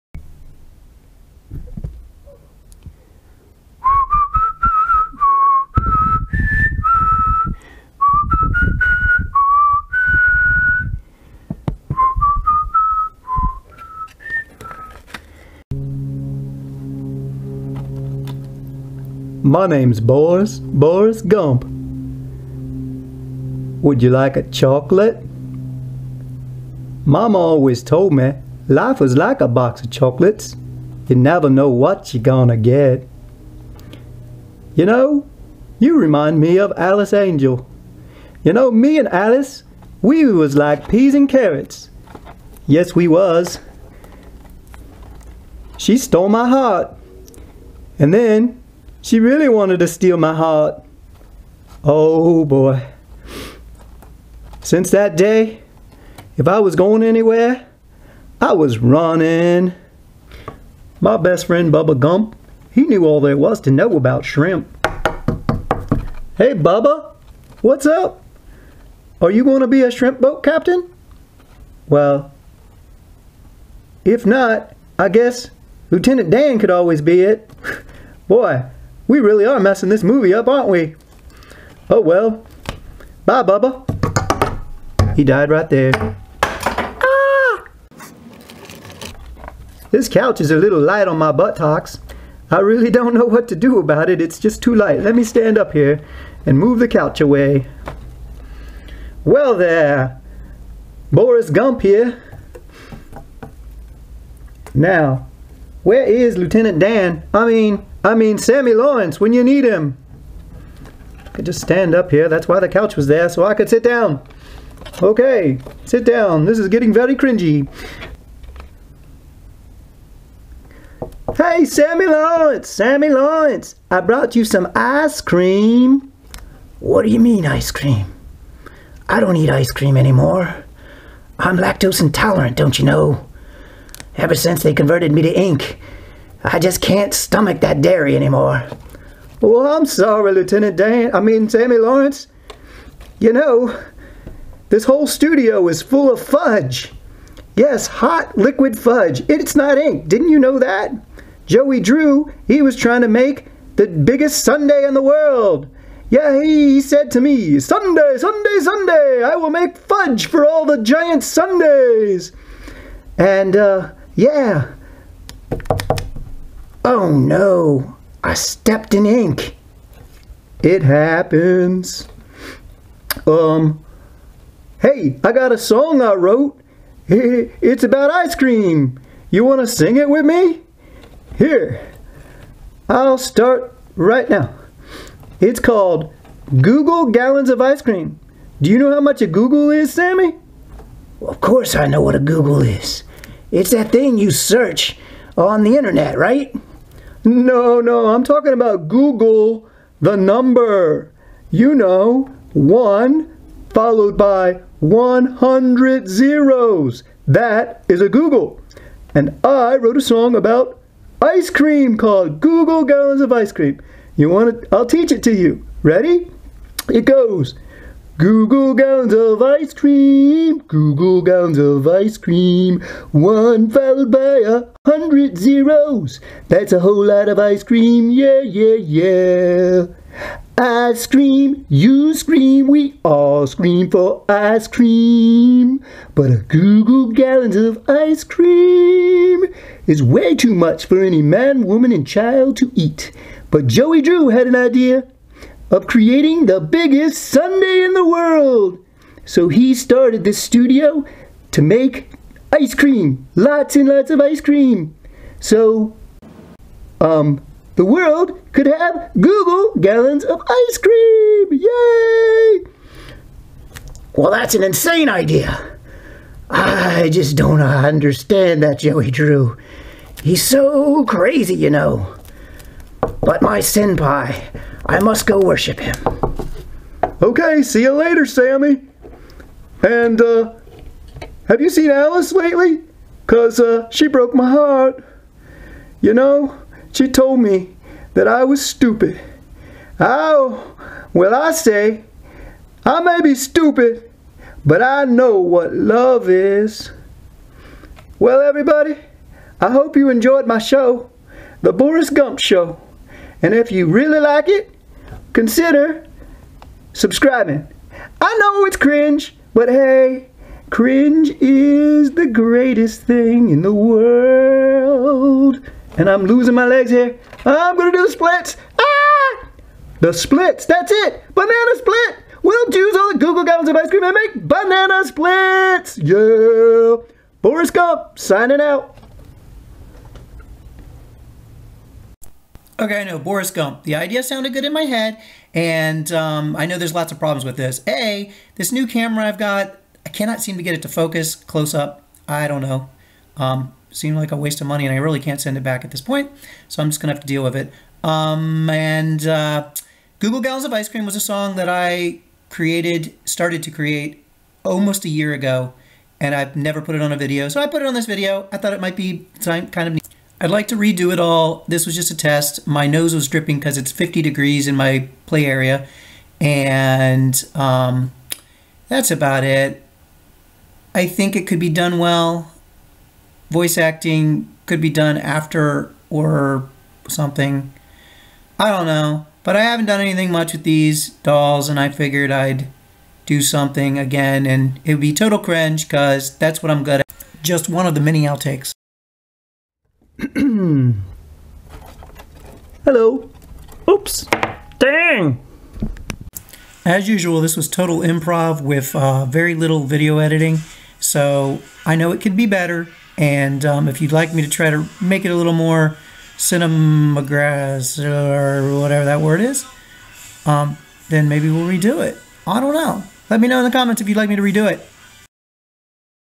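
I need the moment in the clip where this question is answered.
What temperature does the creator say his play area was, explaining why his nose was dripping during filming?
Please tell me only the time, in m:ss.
6:03.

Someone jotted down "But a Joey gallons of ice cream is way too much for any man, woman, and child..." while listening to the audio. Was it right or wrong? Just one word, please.
wrong.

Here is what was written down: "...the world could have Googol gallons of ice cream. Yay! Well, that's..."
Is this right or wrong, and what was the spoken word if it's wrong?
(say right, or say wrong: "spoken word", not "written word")
right.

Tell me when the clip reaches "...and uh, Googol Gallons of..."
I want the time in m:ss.
5:48.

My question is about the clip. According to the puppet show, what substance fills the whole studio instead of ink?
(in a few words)
hot liquid fudge.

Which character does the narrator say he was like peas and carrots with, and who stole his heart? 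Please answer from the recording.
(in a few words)
Alice Angel.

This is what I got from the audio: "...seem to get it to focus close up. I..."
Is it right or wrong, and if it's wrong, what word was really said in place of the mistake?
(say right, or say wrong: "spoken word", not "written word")
right.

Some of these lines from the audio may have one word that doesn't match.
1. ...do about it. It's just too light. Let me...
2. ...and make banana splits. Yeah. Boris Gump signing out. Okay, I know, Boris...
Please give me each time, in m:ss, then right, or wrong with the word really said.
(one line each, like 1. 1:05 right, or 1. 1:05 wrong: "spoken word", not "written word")
1. 1:33 right
2. 5:24 right.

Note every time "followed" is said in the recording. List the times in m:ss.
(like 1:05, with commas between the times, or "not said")
3:23, 3:43.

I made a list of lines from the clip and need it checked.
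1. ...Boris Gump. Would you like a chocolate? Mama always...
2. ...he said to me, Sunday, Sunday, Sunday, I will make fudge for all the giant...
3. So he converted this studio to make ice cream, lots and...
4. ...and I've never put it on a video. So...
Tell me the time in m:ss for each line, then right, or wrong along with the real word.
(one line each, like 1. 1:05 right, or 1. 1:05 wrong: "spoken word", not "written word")
1. 0:20 right
2. 2:36 right
3. 4:09 wrong: "started", not "converted"
4. 5:56 right.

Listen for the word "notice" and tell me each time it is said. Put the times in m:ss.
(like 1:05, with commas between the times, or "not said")
not said.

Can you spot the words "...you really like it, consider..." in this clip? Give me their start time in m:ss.
5:03.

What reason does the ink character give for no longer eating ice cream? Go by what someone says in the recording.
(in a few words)
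lactose intolerant.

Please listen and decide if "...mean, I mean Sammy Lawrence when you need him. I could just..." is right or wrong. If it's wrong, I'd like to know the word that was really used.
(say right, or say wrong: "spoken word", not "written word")
right.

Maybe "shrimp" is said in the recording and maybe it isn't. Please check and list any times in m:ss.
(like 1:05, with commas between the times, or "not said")
1:04, 1:09.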